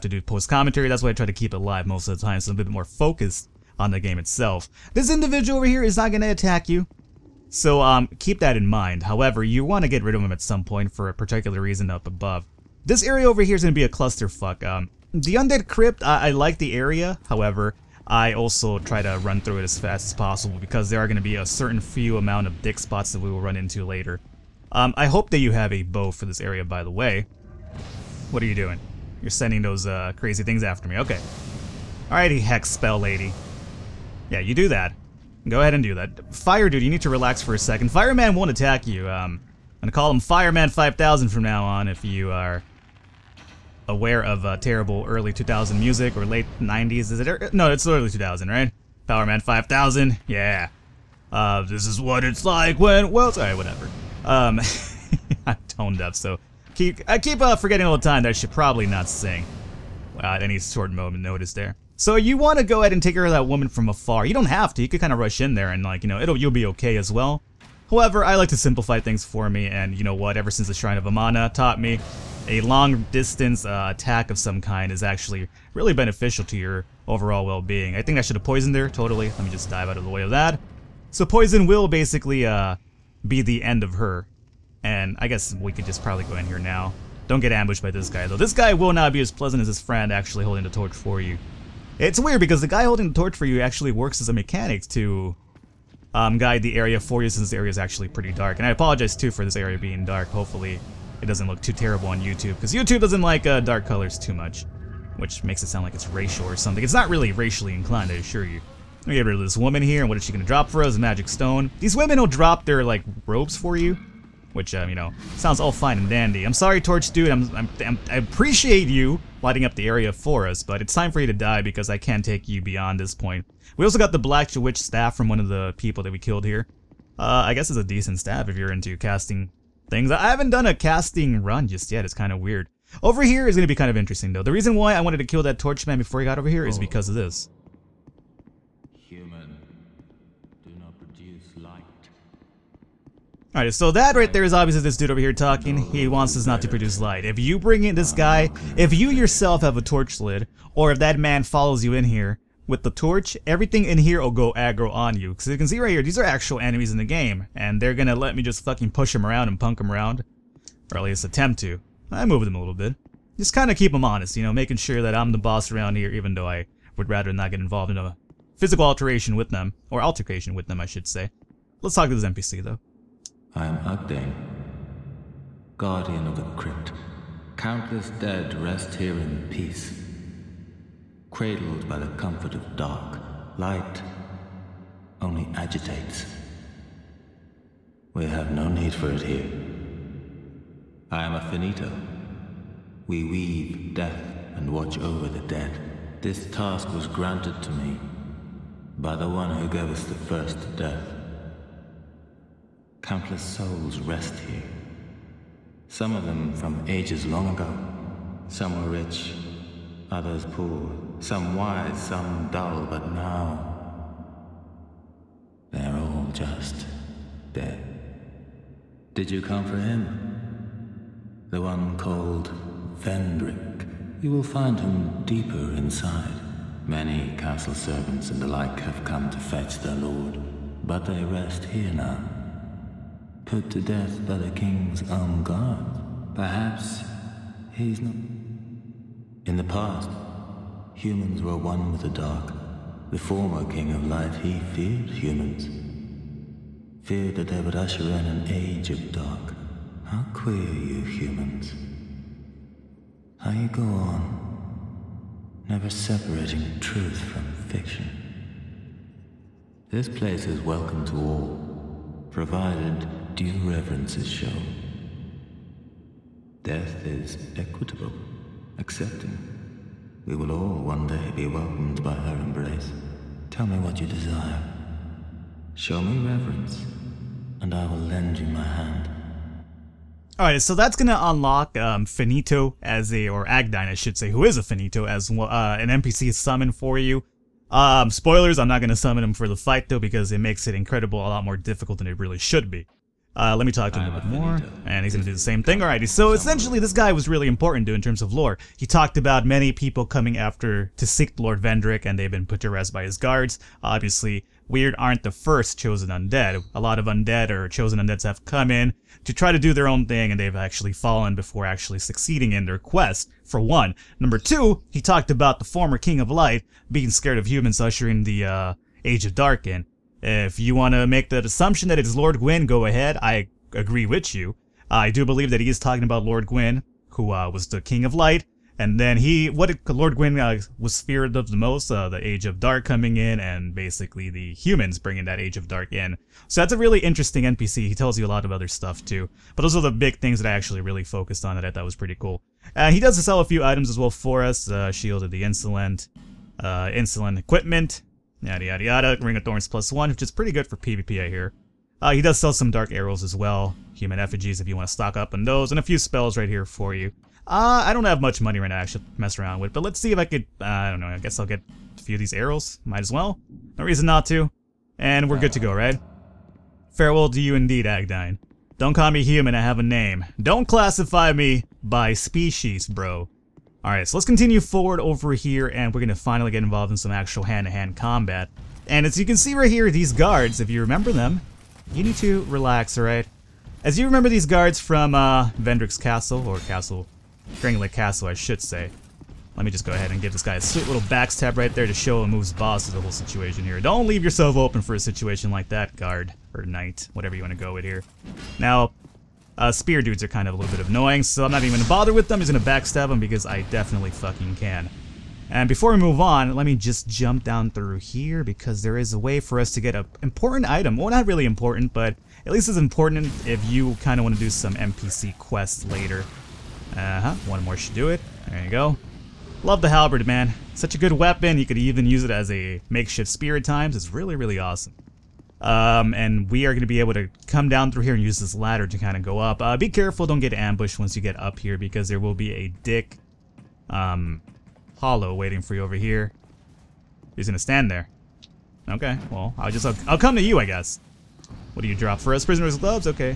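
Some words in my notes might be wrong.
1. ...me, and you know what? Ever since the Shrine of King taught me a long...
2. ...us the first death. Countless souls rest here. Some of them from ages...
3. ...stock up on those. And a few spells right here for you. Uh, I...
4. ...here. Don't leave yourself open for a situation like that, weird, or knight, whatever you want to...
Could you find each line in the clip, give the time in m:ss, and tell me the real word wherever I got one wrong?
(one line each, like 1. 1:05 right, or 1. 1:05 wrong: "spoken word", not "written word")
1. 1:09 wrong: "Amana", not "King"
2. 3:19 right
3. 5:54 right
4. 6:33 wrong: "guard", not "weird".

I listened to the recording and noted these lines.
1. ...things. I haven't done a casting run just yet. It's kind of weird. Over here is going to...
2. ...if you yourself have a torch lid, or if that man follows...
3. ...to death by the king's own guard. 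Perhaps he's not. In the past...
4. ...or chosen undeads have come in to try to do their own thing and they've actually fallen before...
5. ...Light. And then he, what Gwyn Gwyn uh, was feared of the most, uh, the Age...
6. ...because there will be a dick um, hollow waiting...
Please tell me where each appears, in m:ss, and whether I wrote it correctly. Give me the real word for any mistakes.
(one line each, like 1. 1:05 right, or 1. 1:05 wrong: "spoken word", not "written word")
1. 2:09 right
2. 2:28 right
3. 3:53 right
4. 5:07 right
5. 5:28 wrong: "Lord", not "Gwyn"
6. 7:11 right.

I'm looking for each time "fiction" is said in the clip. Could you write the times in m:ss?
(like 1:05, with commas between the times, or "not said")
4:17.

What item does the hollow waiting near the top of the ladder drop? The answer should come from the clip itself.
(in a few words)
Prisoner's gloves.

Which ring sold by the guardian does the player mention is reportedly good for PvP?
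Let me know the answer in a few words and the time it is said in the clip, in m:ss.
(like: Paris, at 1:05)
Ring of Thorns plus one, at 5:49.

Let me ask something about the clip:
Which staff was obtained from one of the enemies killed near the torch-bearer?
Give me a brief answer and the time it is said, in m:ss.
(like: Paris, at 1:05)
Black Witch staff, at 2:04.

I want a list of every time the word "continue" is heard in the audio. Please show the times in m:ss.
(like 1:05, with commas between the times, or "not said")
6:14.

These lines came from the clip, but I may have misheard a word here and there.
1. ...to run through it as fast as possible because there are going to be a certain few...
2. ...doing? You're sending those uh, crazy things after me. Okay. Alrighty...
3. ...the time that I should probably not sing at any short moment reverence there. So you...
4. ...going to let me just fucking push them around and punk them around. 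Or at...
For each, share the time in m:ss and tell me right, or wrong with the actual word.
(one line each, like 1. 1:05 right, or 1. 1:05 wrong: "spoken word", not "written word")
1. 0:19 right
2. 0:28 right
3. 0:57 wrong: "notice", not "reverence"
4. 2:37 right.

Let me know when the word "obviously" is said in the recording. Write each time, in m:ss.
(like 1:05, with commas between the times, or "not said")
2:24, 5:03.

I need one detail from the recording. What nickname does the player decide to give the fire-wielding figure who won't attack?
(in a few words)
Fireman 5000.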